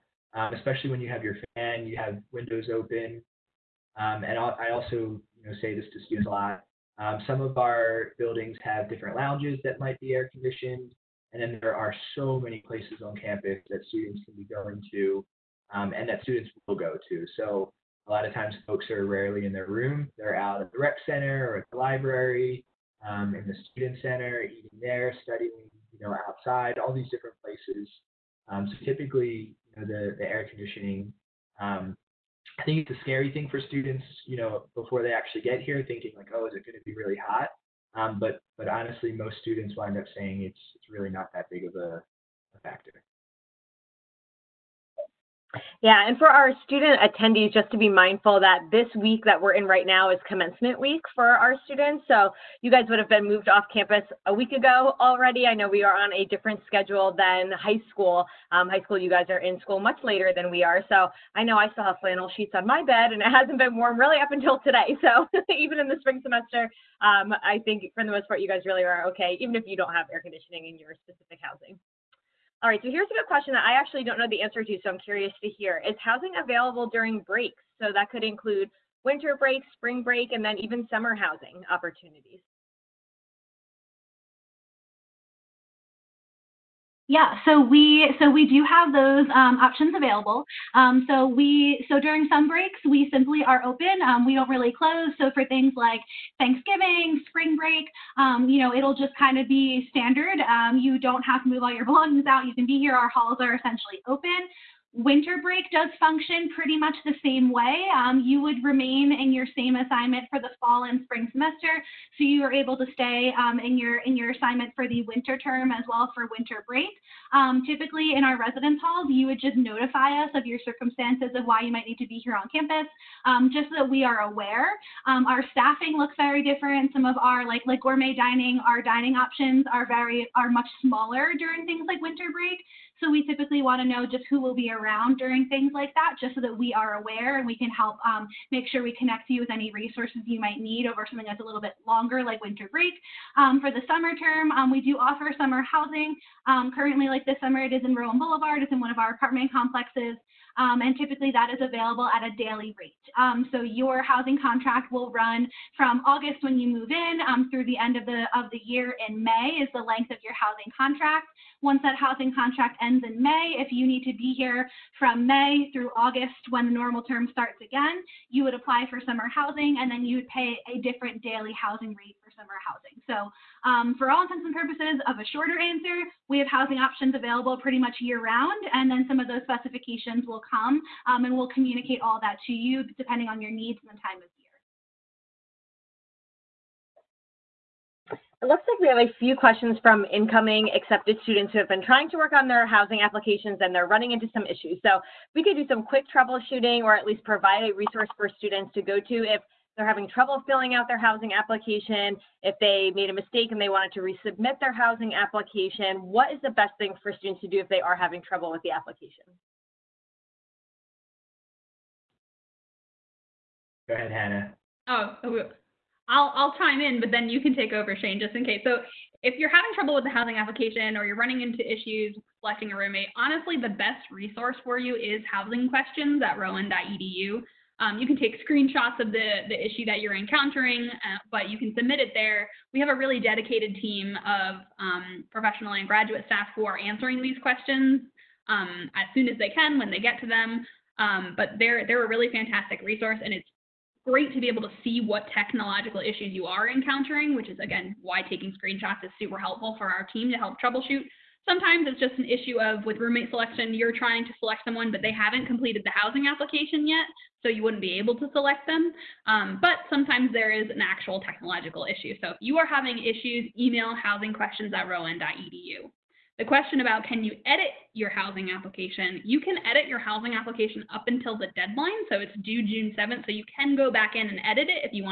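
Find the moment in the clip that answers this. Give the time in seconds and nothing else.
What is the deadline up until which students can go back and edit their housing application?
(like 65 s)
272 s.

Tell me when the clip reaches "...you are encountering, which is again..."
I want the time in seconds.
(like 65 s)
246 s.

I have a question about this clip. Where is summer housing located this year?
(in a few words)
Rowan Boulevard.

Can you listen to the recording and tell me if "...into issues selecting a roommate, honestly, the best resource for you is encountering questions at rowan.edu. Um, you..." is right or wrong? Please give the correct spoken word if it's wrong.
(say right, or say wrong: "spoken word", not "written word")
wrong: "housing", not "encountering".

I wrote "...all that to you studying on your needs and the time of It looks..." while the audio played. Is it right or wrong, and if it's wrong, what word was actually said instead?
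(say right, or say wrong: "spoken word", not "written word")
wrong: "depending", not "studying".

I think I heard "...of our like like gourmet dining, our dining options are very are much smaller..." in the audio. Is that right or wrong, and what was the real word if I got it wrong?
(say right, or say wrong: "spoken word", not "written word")
right.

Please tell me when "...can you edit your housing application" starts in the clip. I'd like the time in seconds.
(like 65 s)
267 s.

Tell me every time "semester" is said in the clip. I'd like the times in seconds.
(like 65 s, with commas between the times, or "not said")
66 s, 111 s.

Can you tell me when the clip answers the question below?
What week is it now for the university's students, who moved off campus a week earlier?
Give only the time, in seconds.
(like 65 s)
50 s.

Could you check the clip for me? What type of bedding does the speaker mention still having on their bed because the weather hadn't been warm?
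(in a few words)
Flannel sheets.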